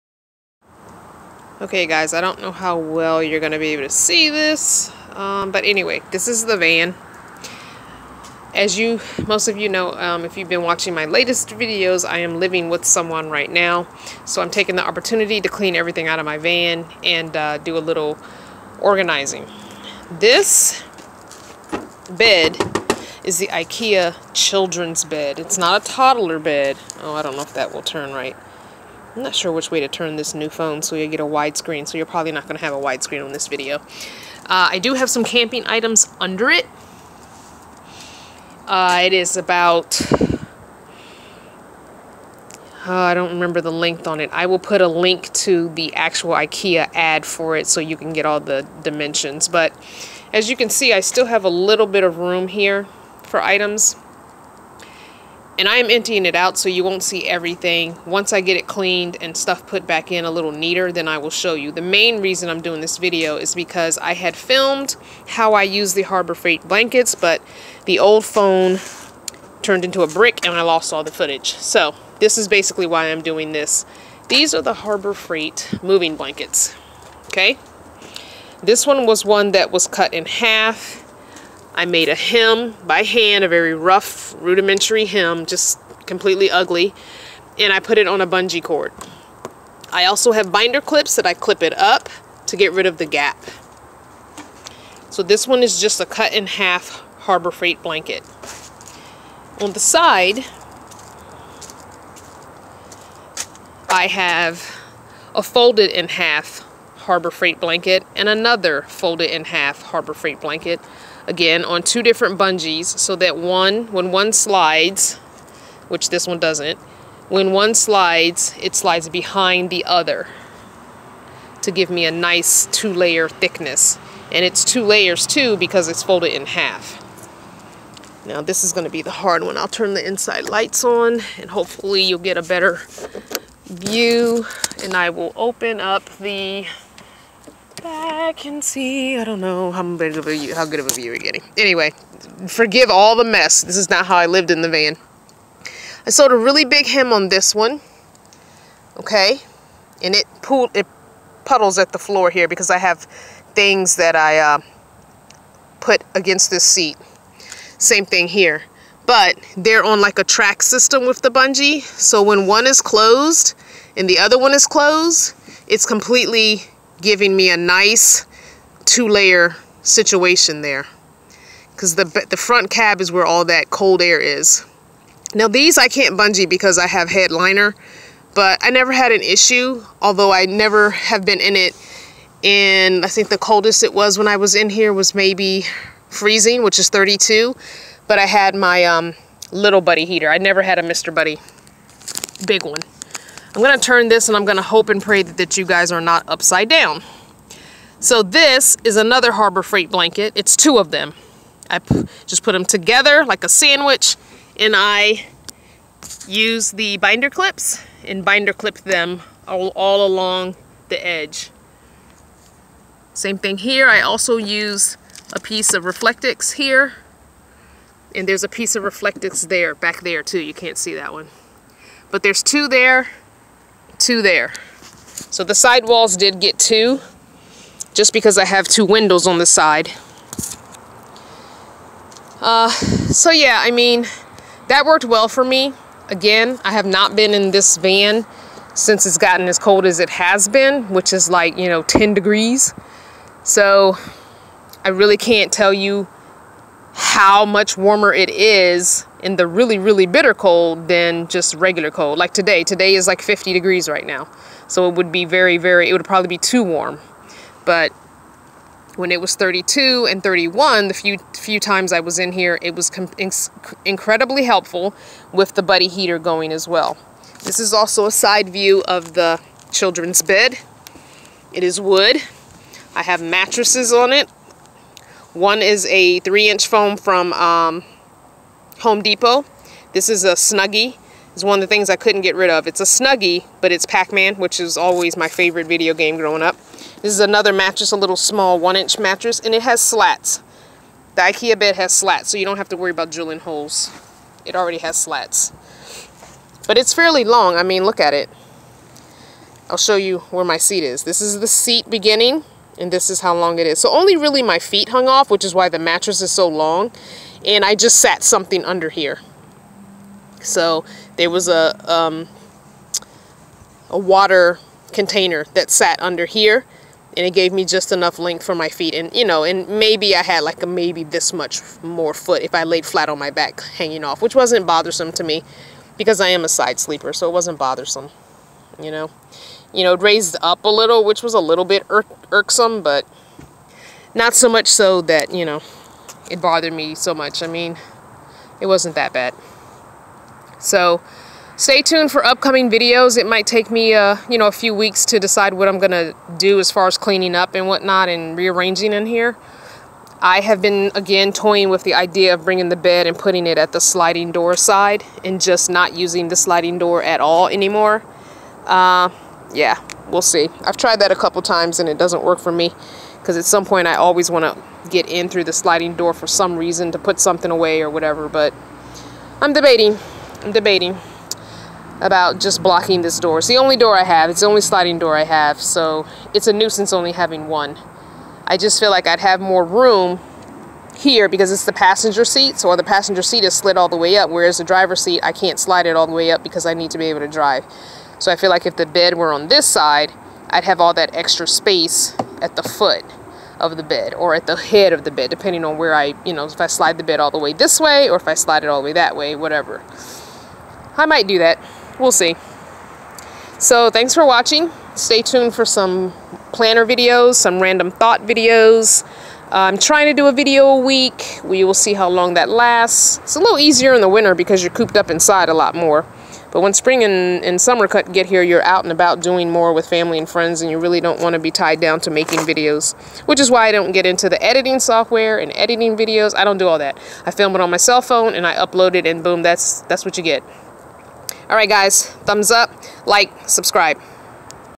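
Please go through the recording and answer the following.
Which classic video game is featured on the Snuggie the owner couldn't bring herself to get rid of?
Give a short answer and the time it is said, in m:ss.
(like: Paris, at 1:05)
Pac-Man, at 4:43.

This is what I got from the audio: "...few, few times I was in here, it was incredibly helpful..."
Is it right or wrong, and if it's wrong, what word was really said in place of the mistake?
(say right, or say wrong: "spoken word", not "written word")
right.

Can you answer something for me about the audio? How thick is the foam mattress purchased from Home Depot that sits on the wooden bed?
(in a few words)
3 inches.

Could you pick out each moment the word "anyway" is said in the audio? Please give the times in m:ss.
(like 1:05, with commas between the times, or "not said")
0:05, 2:21.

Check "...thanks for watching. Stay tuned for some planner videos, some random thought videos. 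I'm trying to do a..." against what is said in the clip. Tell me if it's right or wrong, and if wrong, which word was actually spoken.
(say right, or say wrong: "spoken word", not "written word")
right.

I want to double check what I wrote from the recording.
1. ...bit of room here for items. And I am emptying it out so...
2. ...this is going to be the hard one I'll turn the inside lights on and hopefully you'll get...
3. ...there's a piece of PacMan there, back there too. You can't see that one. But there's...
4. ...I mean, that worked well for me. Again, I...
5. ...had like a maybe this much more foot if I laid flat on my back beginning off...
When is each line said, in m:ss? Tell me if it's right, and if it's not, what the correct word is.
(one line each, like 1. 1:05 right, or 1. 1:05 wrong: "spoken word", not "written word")
1. 0:51 right
2. 2:08 right
3. 3:38 wrong: "Reflectix", not "PacMan"
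4. 3:53 right
5. 5:20 wrong: "hanging", not "beginning".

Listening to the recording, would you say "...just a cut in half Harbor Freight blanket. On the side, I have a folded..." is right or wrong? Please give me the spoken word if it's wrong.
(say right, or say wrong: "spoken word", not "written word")
right.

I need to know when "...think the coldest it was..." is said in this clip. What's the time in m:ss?
3:03.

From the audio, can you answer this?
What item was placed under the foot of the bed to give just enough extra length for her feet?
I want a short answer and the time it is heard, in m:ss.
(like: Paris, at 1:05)
A water container, at 5:13.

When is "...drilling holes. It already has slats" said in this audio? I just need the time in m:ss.
4:53.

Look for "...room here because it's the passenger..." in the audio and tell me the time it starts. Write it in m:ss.
6:19.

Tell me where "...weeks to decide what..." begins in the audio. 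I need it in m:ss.
5:44.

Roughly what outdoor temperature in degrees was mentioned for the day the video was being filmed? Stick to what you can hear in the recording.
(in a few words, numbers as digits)
50 degrees.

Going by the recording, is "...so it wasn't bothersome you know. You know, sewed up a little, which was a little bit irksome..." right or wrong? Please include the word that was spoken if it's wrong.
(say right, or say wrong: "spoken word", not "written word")
wrong: "raised", not "sewed".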